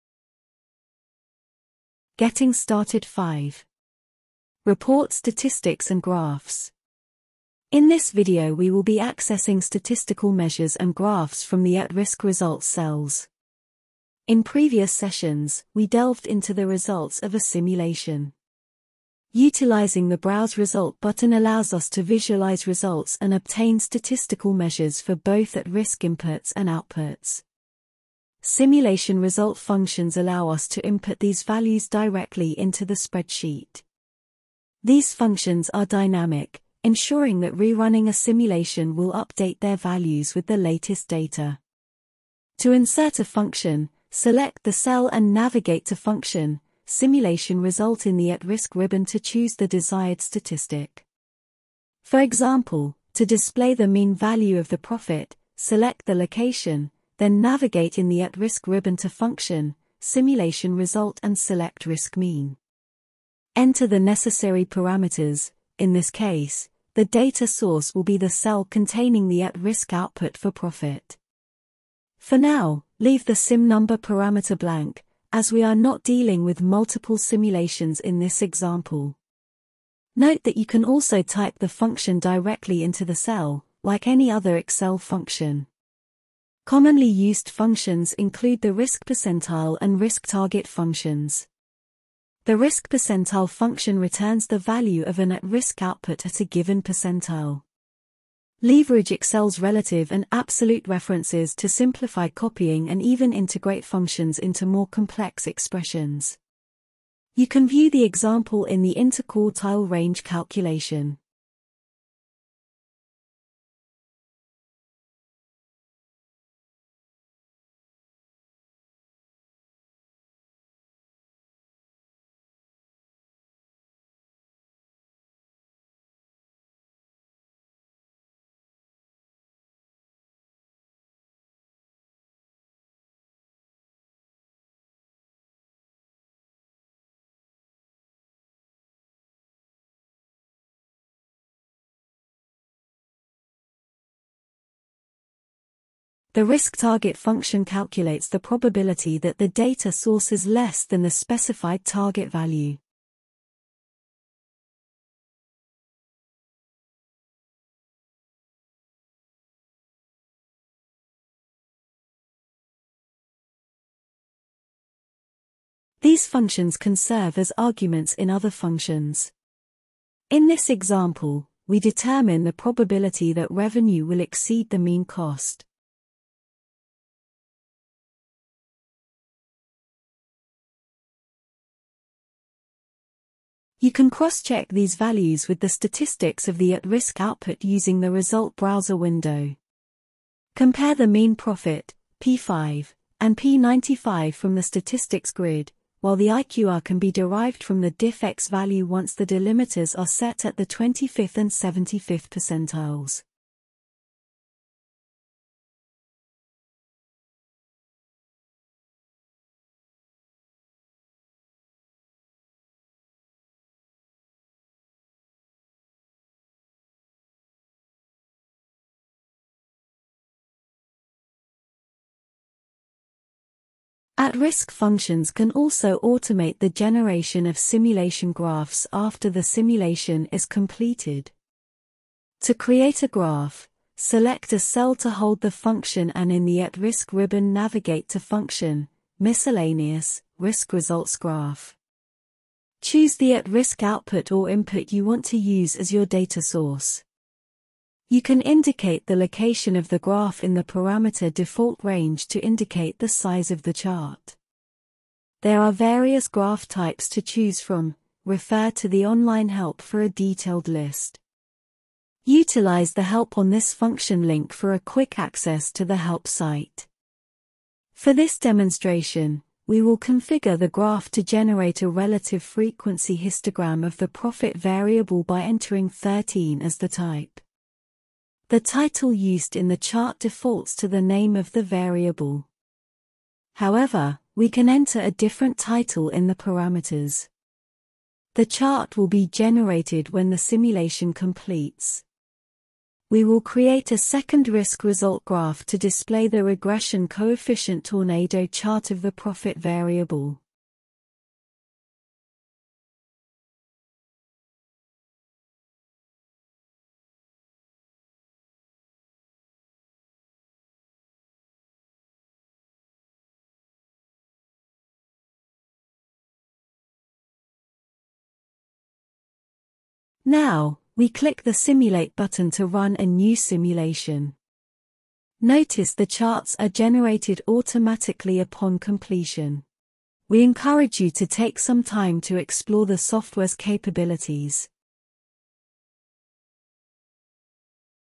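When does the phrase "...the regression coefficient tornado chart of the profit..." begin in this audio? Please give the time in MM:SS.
04:56.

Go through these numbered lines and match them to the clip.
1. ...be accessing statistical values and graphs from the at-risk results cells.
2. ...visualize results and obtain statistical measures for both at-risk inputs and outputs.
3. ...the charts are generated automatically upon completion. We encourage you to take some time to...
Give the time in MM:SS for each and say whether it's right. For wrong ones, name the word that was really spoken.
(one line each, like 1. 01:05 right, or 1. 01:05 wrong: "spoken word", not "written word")
1. 00:08 wrong: "measures", not "values"
2. 00:22 right
3. 05:25 right.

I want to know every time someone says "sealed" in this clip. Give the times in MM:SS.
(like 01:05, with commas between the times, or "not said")
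not said.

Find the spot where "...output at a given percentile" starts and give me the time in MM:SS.
01:35.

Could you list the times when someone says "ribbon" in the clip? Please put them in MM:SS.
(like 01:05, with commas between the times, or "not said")
00:48, 00:58, 03:57.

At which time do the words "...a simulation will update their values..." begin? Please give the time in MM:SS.
00:38.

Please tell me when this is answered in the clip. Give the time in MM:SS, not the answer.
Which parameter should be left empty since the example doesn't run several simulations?
01:13.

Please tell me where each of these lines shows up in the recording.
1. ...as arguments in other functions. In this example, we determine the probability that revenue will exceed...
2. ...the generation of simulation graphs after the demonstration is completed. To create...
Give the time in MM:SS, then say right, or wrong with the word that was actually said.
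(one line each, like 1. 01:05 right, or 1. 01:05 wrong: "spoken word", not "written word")
1. 02:47 right
2. 03:46 wrong: "simulation", not "demonstration".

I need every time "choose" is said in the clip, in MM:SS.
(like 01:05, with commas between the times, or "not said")
00:49, 04:02, 04:17.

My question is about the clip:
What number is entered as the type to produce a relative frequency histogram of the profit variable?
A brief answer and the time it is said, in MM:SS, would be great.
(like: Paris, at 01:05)
13, at 04:35.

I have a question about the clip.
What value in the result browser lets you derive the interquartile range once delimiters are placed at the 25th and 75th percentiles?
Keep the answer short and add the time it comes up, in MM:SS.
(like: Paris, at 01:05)
diffx, at 03:17.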